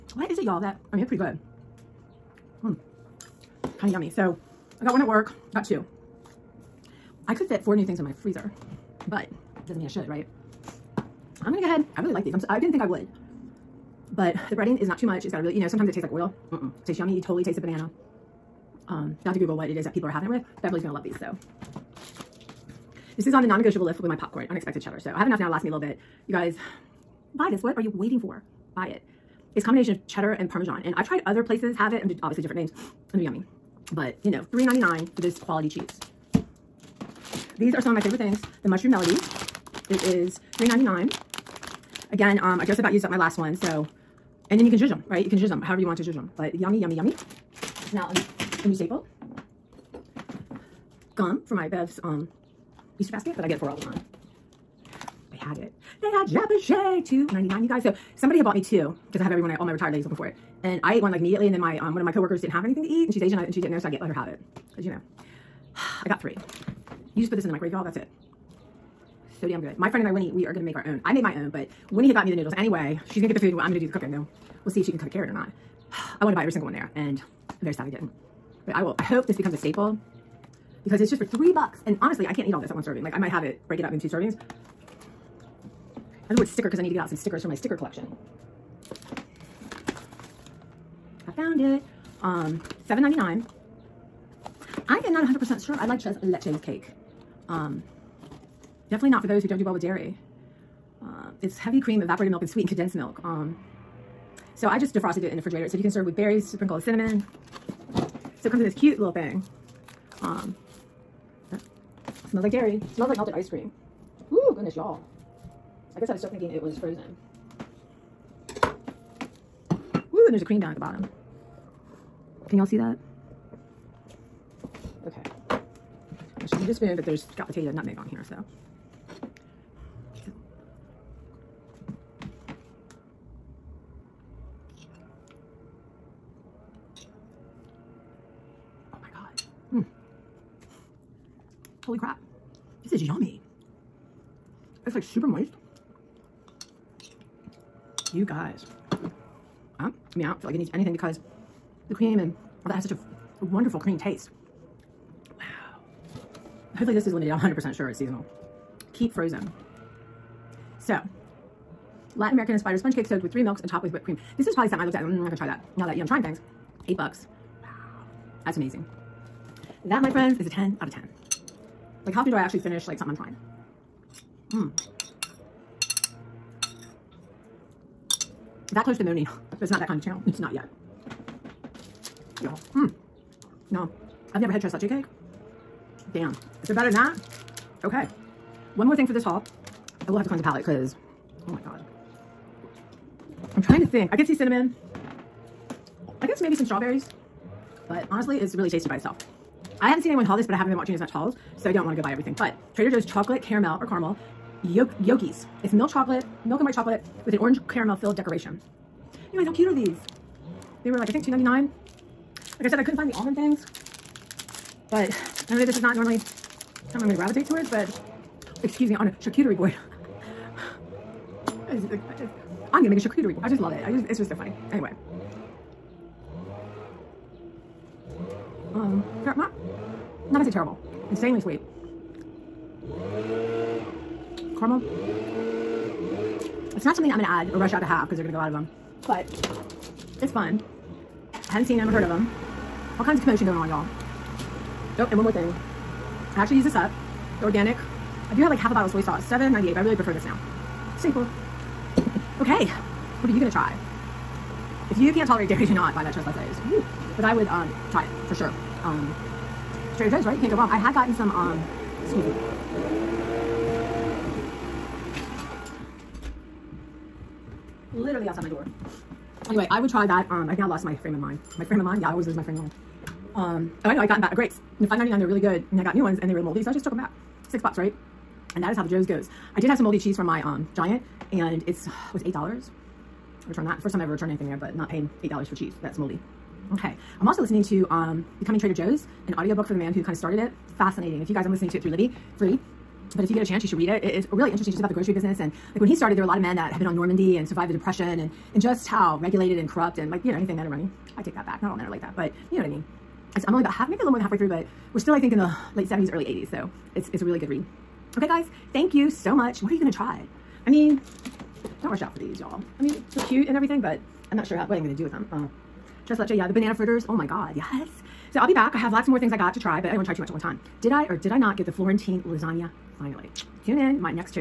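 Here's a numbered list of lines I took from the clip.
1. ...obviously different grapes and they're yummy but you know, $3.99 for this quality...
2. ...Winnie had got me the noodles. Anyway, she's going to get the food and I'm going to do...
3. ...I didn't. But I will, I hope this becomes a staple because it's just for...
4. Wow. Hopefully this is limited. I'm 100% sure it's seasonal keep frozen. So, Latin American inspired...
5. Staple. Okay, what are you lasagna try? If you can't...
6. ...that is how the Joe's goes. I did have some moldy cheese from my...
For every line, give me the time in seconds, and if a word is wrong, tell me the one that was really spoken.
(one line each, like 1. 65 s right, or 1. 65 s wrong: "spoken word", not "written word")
1. 32 s wrong: "names", not "grapes"
2. 71 s right
3. 77 s right
4. 155 s right
5. 250 s wrong: "gonna", not "lasagna"
6. 278 s right.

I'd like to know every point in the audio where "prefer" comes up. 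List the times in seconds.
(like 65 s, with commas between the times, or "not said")
249 s.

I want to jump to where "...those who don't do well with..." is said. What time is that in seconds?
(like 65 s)
99 s.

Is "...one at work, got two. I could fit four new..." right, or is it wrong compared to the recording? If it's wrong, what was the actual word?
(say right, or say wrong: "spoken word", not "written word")
right.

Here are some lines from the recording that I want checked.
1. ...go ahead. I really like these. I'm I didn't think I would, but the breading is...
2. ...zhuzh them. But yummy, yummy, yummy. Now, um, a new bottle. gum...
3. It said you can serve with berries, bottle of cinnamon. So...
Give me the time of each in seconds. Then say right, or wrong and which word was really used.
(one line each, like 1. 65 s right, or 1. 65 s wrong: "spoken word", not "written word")
1. 11 s right
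2. 46 s wrong: "staple", not "bottle"
3. 105 s wrong: "sprinkle", not "bottle".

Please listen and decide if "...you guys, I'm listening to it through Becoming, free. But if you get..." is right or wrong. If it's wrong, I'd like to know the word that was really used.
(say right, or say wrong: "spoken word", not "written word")
wrong: "Libby", not "Becoming".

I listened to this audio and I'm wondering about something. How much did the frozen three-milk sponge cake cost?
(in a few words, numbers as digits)
$7.99.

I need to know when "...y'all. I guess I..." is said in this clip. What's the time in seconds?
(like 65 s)
114 s.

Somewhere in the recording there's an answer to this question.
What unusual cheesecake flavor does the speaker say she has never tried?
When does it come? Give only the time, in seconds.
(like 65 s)
184 s.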